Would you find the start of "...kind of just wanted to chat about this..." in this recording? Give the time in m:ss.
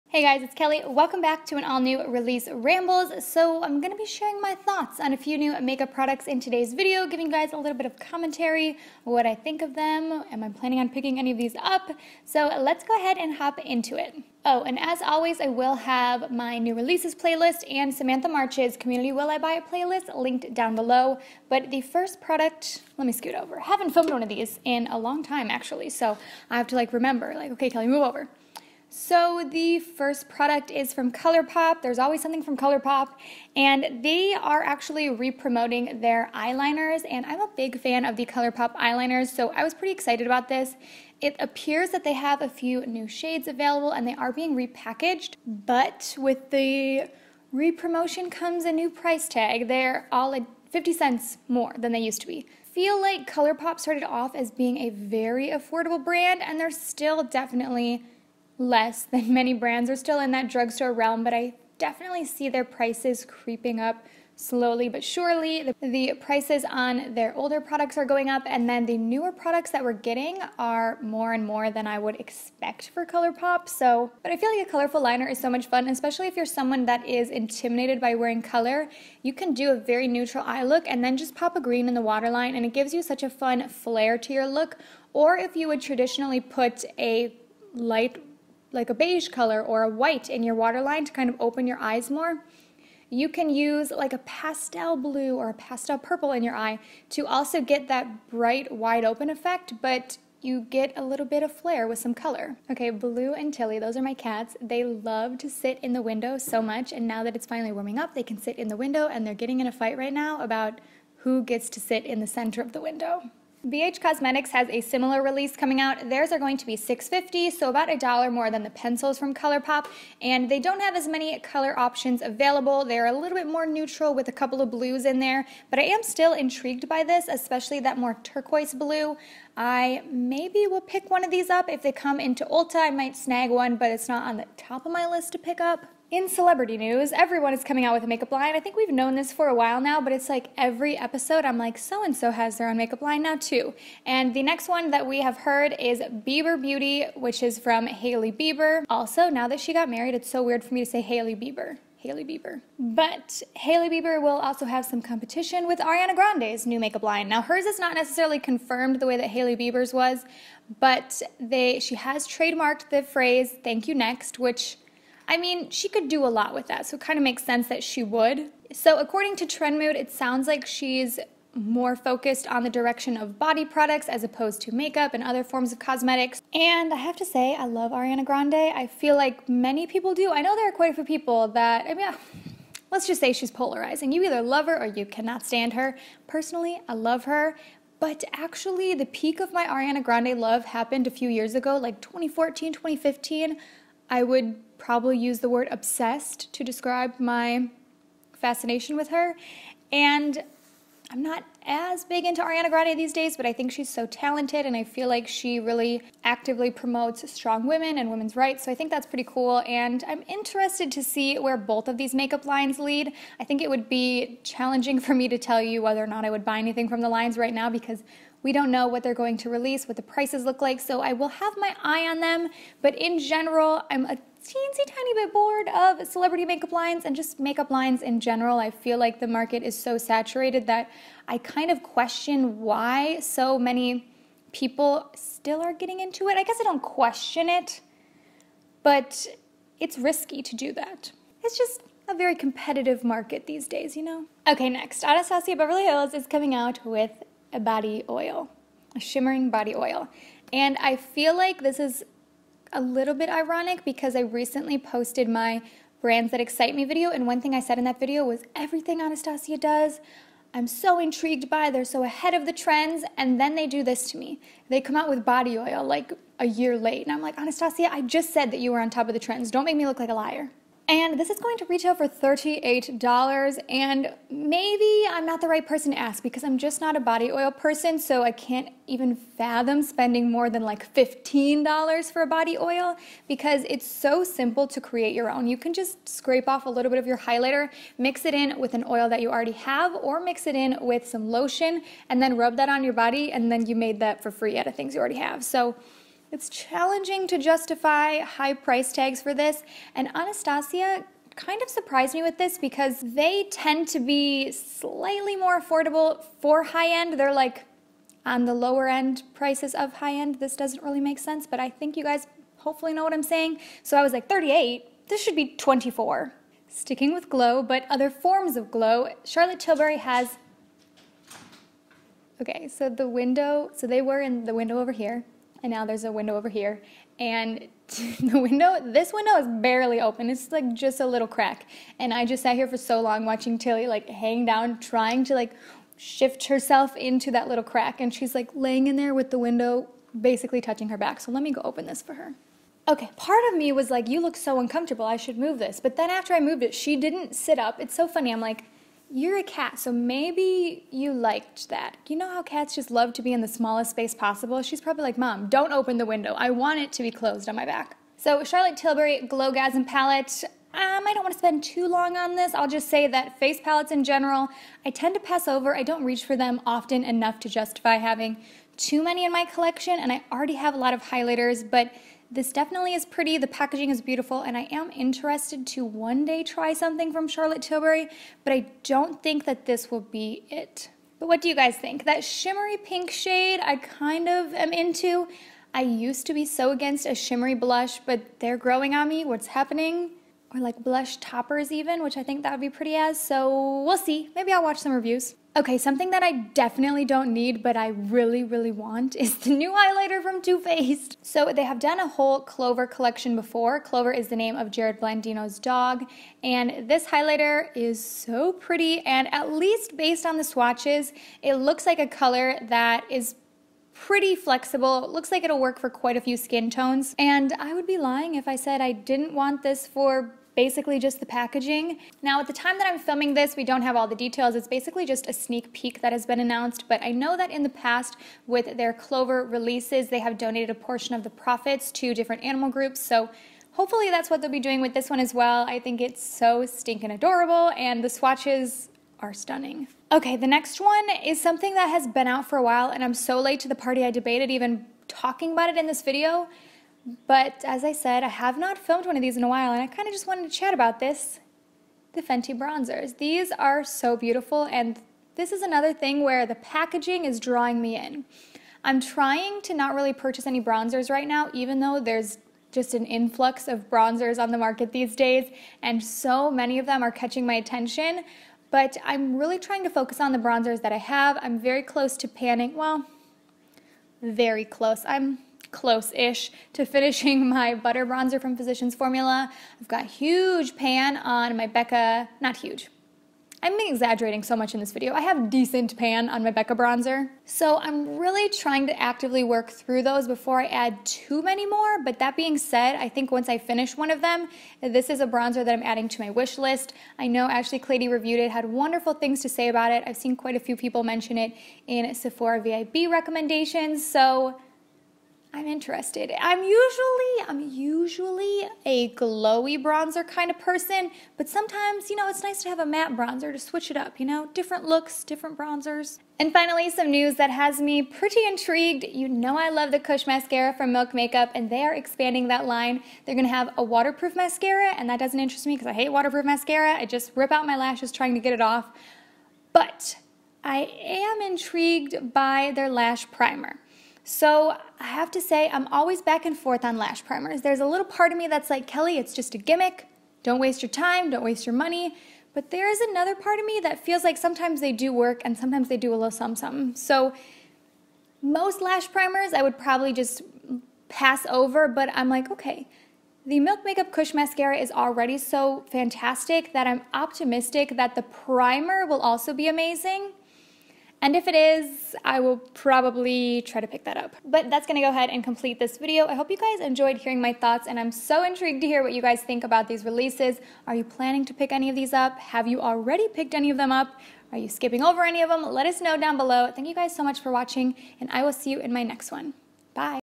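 7:29.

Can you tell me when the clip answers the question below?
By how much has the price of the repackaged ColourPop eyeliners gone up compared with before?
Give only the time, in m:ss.
0:50.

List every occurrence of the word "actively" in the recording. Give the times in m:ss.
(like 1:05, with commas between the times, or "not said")
3:26, 8:08.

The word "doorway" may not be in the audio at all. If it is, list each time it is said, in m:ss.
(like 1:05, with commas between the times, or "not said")
not said.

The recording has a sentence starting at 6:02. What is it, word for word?
I'll just say that face palettes in general, I tend to pass over.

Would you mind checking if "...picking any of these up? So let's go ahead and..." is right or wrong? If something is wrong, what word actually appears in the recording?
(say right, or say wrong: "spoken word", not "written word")
right.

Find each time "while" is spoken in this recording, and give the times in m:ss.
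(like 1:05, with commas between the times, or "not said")
2:19, 7:22, 7:29.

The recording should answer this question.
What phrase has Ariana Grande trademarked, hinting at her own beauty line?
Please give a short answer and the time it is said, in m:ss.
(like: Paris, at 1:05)
thank you next, at 2:43.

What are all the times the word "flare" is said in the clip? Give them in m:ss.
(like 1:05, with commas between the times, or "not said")
1:23, 1:41.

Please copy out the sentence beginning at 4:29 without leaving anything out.
Don't make me look like a liar.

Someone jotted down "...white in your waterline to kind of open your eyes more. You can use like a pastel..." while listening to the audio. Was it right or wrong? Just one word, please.
right.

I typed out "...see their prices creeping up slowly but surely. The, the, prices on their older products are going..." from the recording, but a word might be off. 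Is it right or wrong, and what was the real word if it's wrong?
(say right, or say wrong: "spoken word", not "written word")
right.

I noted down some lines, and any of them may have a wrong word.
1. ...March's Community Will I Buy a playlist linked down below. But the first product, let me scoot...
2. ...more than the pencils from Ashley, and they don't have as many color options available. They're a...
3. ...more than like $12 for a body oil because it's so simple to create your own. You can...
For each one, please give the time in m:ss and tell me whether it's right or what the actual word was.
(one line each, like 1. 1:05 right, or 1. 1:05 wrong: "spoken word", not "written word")
1. 0:18 right
2. 1:58 wrong: "ColourPop", not "Ashley"
3. 4:40 wrong: "15", not "12".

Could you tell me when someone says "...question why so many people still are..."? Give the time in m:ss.
3:51.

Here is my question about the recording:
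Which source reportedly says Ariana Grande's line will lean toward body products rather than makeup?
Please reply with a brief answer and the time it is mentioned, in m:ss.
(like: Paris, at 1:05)
Trend Mood, at 2:49.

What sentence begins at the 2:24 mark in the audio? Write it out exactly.
And the next one that we have heard is Bieber Beauty, which is from Hailey Bieber.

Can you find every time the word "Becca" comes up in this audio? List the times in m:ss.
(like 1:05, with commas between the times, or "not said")
8:01, 8:06.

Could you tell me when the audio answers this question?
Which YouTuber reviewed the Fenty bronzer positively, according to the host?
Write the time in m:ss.
8:17.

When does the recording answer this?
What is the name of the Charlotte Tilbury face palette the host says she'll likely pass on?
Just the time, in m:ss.
5:59.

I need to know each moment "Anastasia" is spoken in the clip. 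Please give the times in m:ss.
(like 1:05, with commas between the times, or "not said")
4:05, 4:19, 4:27, 5:00.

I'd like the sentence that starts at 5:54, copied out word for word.
She's probably like, Mom, don't open the window.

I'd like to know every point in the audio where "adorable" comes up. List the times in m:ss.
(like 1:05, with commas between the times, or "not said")
7:17.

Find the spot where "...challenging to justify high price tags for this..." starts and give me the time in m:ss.
4:56.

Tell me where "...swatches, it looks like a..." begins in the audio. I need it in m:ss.
6:50.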